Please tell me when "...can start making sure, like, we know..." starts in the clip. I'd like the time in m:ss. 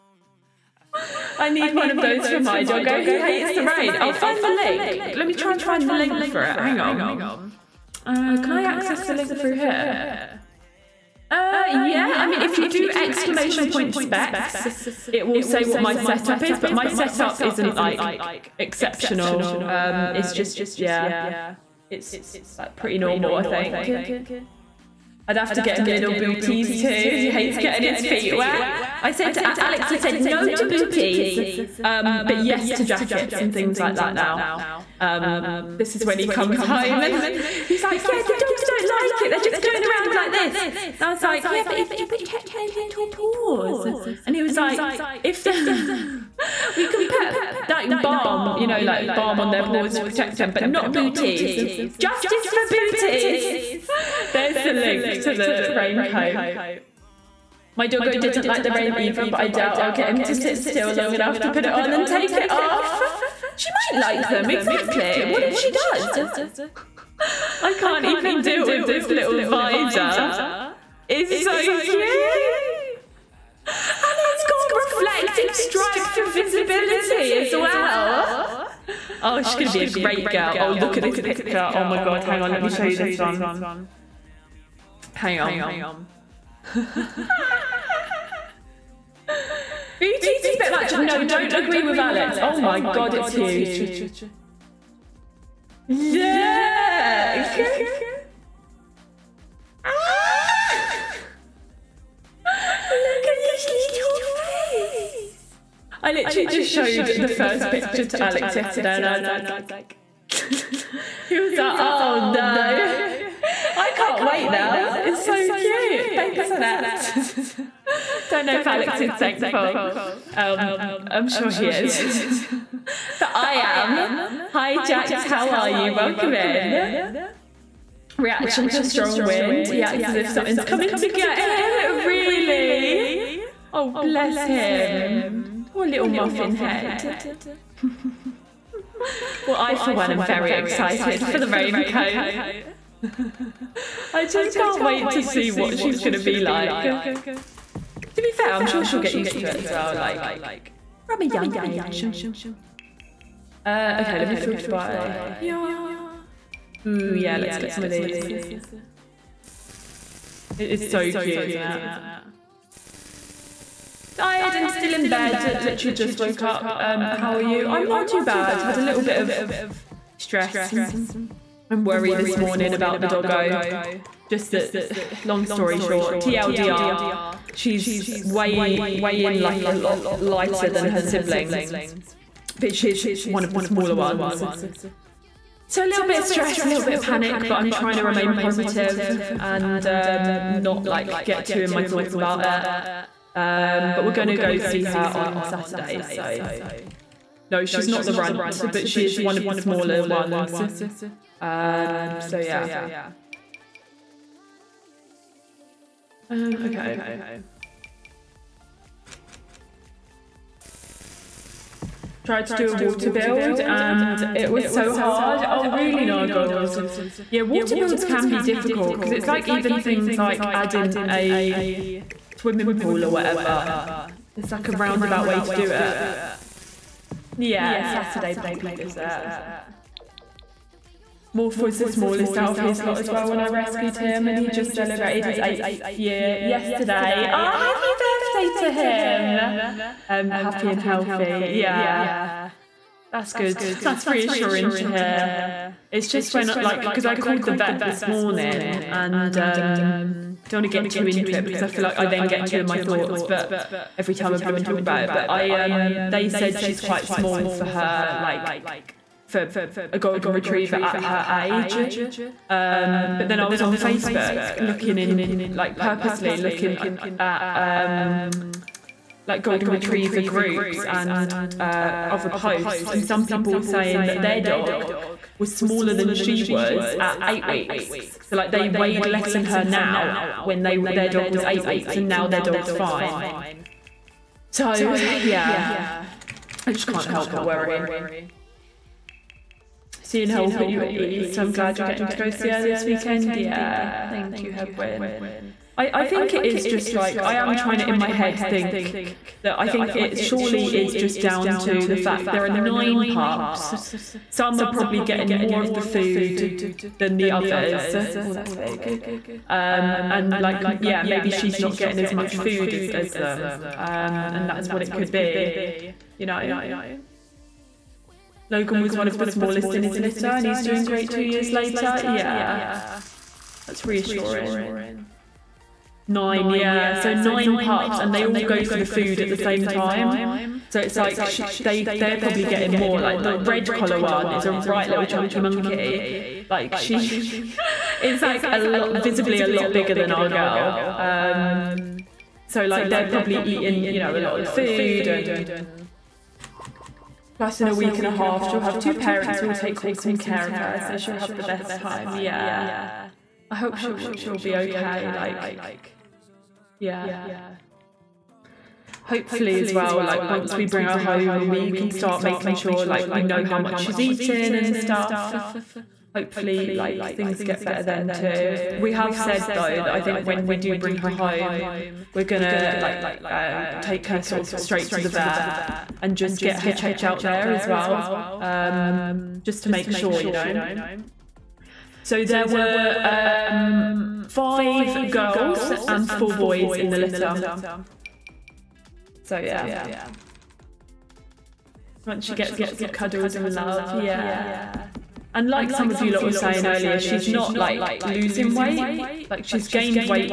6:01.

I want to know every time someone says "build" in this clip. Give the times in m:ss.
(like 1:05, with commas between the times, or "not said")
3:33, 3:37.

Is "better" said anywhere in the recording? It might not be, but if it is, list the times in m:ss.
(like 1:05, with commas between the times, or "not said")
6:07.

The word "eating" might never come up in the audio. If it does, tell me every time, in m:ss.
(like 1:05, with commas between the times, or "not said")
5:43, 6:03.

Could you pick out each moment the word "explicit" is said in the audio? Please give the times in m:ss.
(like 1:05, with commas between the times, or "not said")
not said.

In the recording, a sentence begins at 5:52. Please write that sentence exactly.
Yeah, I hope she'll she'll be okay.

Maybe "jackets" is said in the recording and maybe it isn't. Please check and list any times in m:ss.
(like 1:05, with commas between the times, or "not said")
0:32.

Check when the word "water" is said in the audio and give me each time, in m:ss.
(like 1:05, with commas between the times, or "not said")
3:32, 3:37.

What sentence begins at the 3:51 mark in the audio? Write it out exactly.
Morph was the smallest out of his lot as well when I rescued him, and he just celebrated his eighth year yesterday.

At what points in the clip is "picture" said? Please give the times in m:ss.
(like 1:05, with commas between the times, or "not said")
1:21, 1:47.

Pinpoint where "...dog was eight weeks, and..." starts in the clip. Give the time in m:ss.
4:41.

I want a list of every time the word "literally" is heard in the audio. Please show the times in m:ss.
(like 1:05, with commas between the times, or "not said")
1:46, 2:45.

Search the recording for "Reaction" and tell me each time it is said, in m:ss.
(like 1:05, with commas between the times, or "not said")
2:08.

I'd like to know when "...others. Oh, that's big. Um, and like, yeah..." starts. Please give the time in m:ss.
5:07.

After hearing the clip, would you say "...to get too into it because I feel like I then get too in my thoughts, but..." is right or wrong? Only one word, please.
right.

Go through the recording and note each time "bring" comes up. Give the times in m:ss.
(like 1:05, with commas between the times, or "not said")
6:00, 6:10.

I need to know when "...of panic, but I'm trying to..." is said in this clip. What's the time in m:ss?
3:06.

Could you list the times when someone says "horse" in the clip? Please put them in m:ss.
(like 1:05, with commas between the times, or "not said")
not said.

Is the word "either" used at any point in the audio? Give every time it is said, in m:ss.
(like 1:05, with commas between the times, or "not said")
0:58.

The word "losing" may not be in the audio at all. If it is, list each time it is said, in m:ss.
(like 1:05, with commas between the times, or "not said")
6:38.